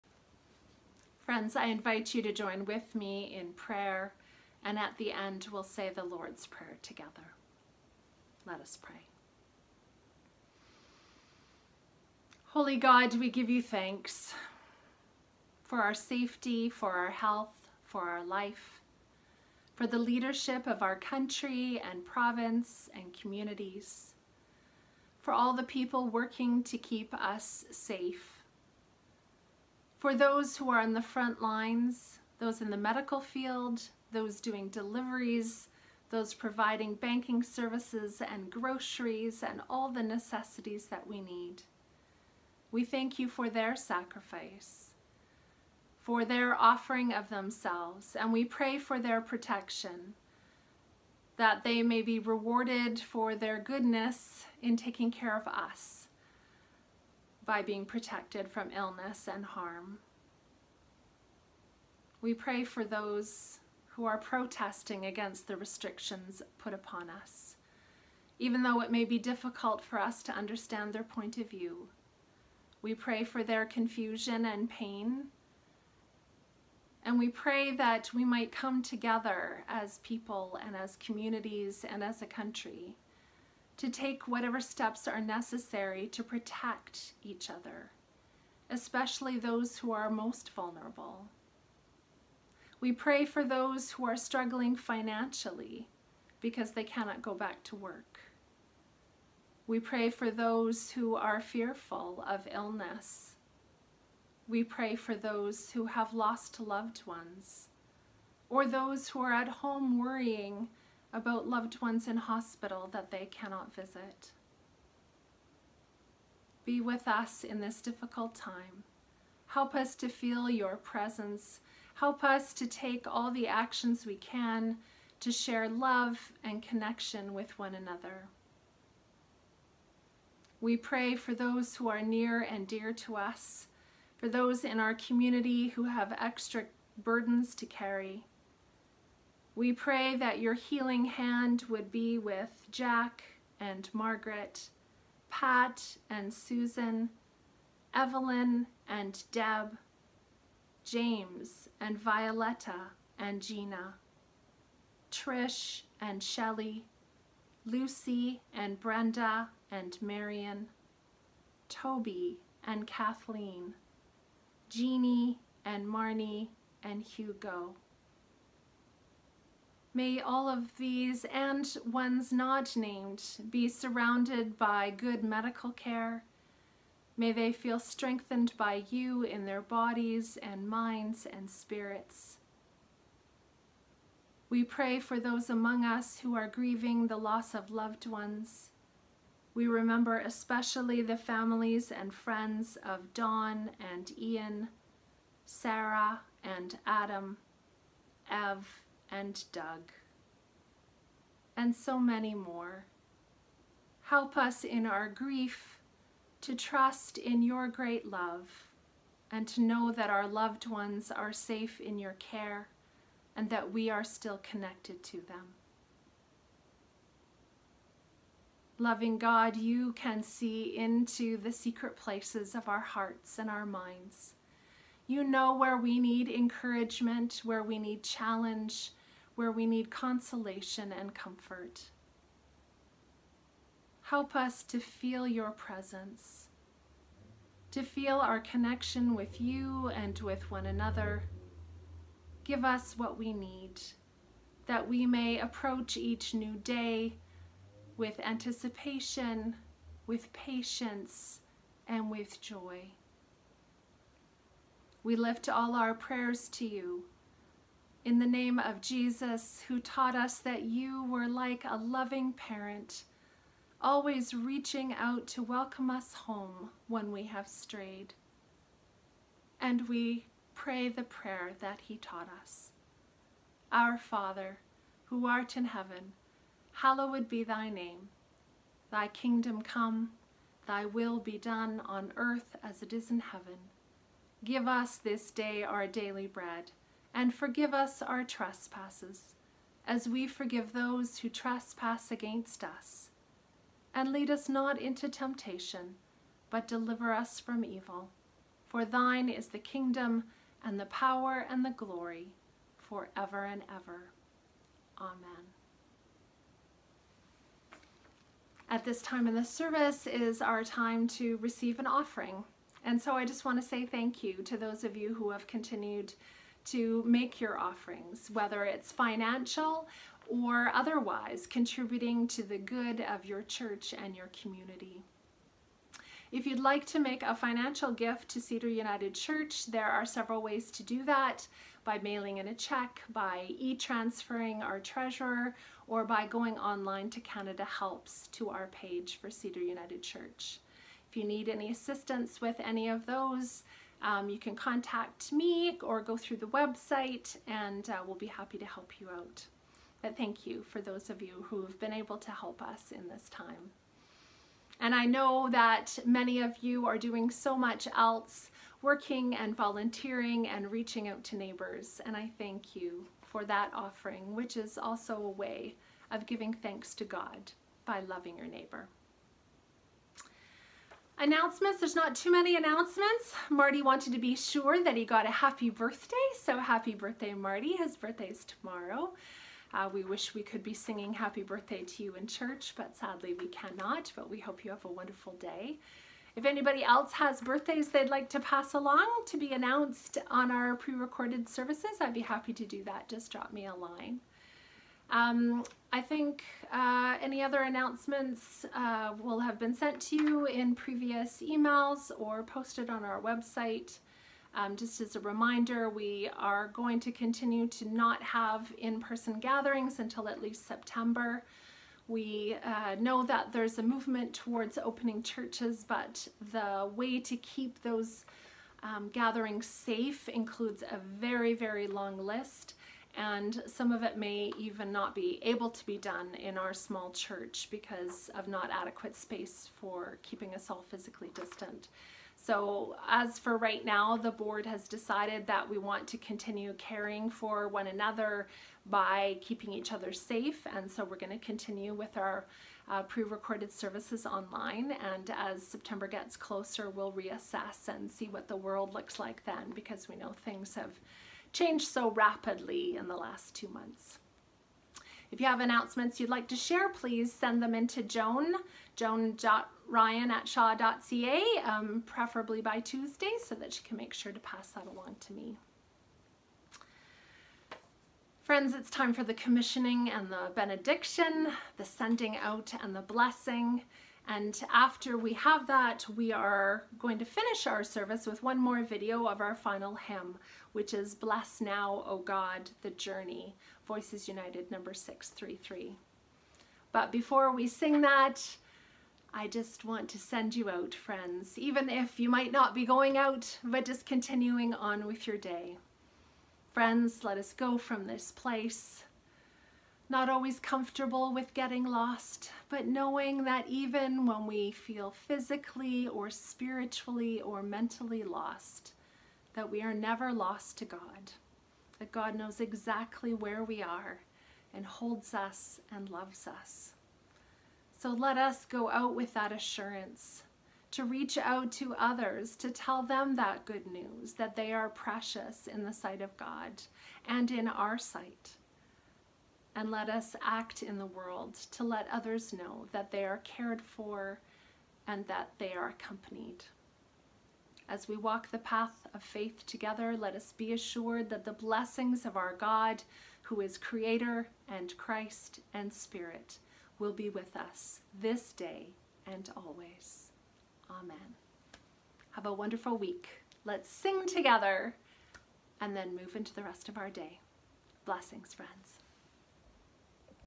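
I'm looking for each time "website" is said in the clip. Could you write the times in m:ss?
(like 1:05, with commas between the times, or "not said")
5:46, 6:43.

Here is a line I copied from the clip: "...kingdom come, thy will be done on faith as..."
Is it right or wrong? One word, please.
wrong.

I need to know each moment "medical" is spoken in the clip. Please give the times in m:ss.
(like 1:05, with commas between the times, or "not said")
0:32, 2:55.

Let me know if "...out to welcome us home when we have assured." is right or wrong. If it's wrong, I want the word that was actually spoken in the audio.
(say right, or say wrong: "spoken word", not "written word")
wrong: "strayed", not "assured".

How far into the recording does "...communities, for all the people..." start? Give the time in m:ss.
0:23.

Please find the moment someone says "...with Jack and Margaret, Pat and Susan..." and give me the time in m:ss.
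2:22.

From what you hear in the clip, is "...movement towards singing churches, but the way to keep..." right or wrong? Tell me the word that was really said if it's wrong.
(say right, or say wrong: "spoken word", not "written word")
wrong: "opening", not "singing".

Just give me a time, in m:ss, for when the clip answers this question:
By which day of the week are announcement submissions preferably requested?
7:42.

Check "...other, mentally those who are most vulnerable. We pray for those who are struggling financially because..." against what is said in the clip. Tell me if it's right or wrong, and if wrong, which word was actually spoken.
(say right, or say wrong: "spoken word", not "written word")
wrong: "especially", not "mentally".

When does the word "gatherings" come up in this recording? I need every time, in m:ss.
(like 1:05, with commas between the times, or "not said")
6:49, 6:59.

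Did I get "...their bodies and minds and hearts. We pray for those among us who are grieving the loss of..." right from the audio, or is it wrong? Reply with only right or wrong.
wrong.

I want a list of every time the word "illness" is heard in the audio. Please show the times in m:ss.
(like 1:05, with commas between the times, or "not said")
0:58, 1:42.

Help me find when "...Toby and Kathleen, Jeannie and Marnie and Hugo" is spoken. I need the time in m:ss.
2:41.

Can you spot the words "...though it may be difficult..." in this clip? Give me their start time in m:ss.
1:08.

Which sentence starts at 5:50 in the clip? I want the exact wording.
But thank you for those of you who have been able to help us in this time.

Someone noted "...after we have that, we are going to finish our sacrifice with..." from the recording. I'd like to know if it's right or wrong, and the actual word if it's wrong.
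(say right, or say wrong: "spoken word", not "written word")
wrong: "service", not "sacrifice".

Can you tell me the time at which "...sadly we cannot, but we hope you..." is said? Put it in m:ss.
6:22.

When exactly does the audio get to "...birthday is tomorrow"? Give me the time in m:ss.
6:17.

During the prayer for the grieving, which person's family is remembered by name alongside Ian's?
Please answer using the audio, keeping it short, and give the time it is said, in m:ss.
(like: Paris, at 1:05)
Don, at 3:13.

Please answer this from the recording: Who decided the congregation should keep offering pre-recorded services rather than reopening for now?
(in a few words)
the board.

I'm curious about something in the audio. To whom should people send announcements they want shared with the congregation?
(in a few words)
Joan.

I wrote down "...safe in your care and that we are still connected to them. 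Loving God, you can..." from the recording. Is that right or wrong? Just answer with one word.
right.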